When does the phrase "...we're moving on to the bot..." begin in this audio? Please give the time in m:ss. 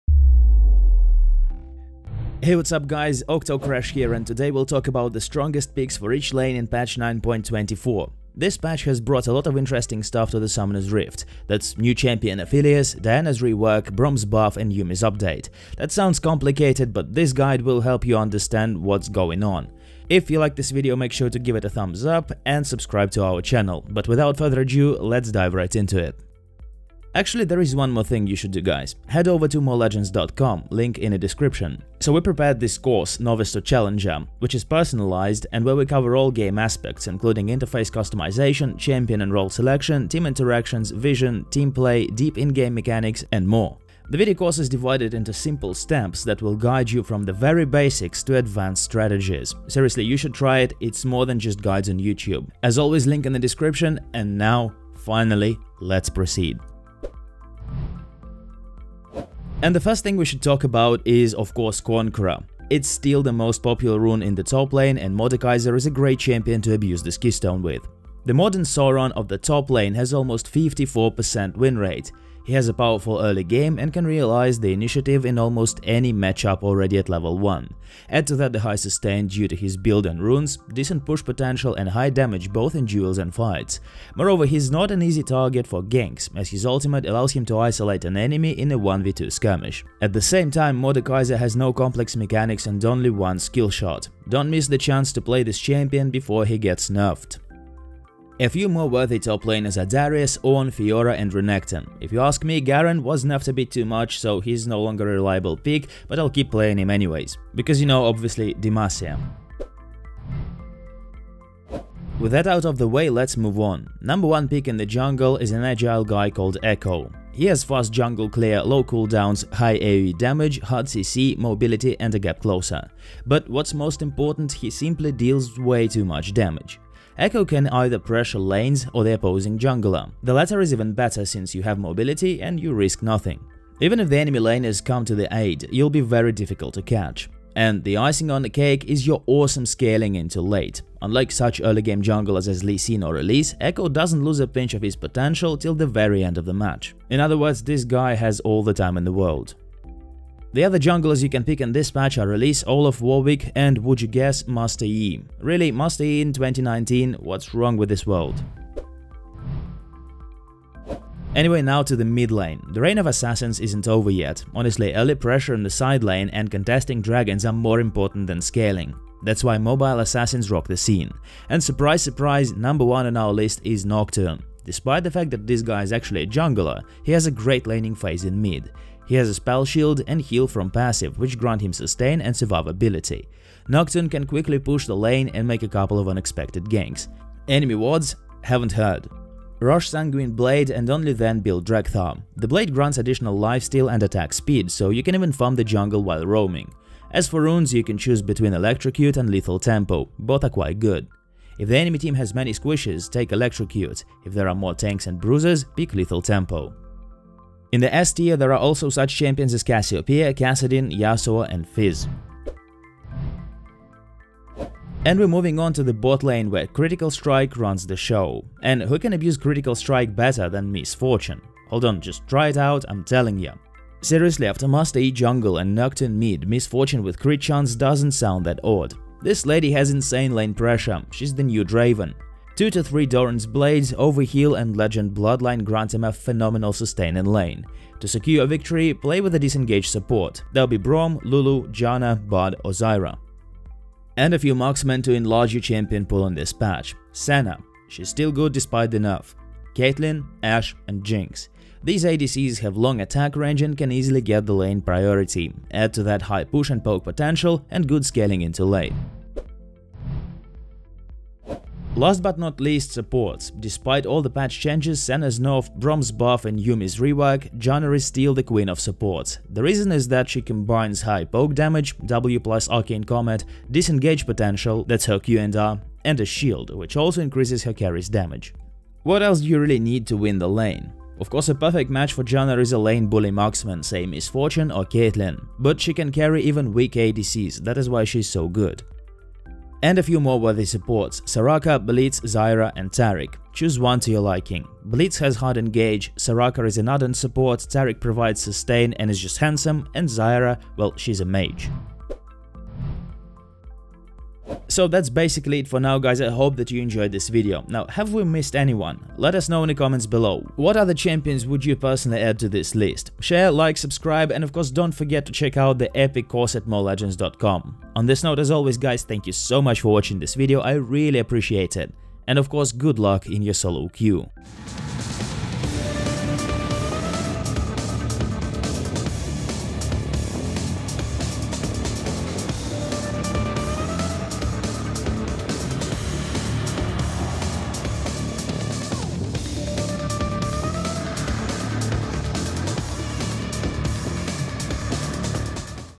3:35.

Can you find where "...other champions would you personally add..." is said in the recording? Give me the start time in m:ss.
5:10.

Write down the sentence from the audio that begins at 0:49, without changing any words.
Seriously, you should try it, it's more than just guides on YouTube.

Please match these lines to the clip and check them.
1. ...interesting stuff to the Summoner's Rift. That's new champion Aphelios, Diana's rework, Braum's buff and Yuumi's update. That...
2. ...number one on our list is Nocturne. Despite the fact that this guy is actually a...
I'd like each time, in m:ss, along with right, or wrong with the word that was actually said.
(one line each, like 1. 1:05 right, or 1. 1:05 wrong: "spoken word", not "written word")
1. 0:09 right
2. 2:52 right.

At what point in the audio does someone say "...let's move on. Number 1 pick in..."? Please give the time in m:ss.
1:53.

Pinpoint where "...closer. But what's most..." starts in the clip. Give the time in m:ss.
2:02.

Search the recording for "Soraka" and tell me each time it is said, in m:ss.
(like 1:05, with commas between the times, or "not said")
4:51, 4:56.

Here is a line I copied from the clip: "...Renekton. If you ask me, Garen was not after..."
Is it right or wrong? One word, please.
right.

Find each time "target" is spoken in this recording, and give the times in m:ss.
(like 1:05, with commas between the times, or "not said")
1:25.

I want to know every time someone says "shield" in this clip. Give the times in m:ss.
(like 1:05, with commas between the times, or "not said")
2:59, 4:36.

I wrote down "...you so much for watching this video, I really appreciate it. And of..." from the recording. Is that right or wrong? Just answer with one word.
right.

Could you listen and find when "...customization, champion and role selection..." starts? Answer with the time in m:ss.
0:37.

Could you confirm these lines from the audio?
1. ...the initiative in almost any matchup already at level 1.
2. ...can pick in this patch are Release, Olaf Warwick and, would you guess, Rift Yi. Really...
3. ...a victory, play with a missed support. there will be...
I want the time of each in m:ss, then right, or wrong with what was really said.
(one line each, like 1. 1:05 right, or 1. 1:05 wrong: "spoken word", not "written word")
1. 1:14 right
2. 2:31 wrong: "Master", not "Rift"
3. 3:58 wrong: "disengaged", not "missed".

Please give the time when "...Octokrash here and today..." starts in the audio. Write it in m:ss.
0:03.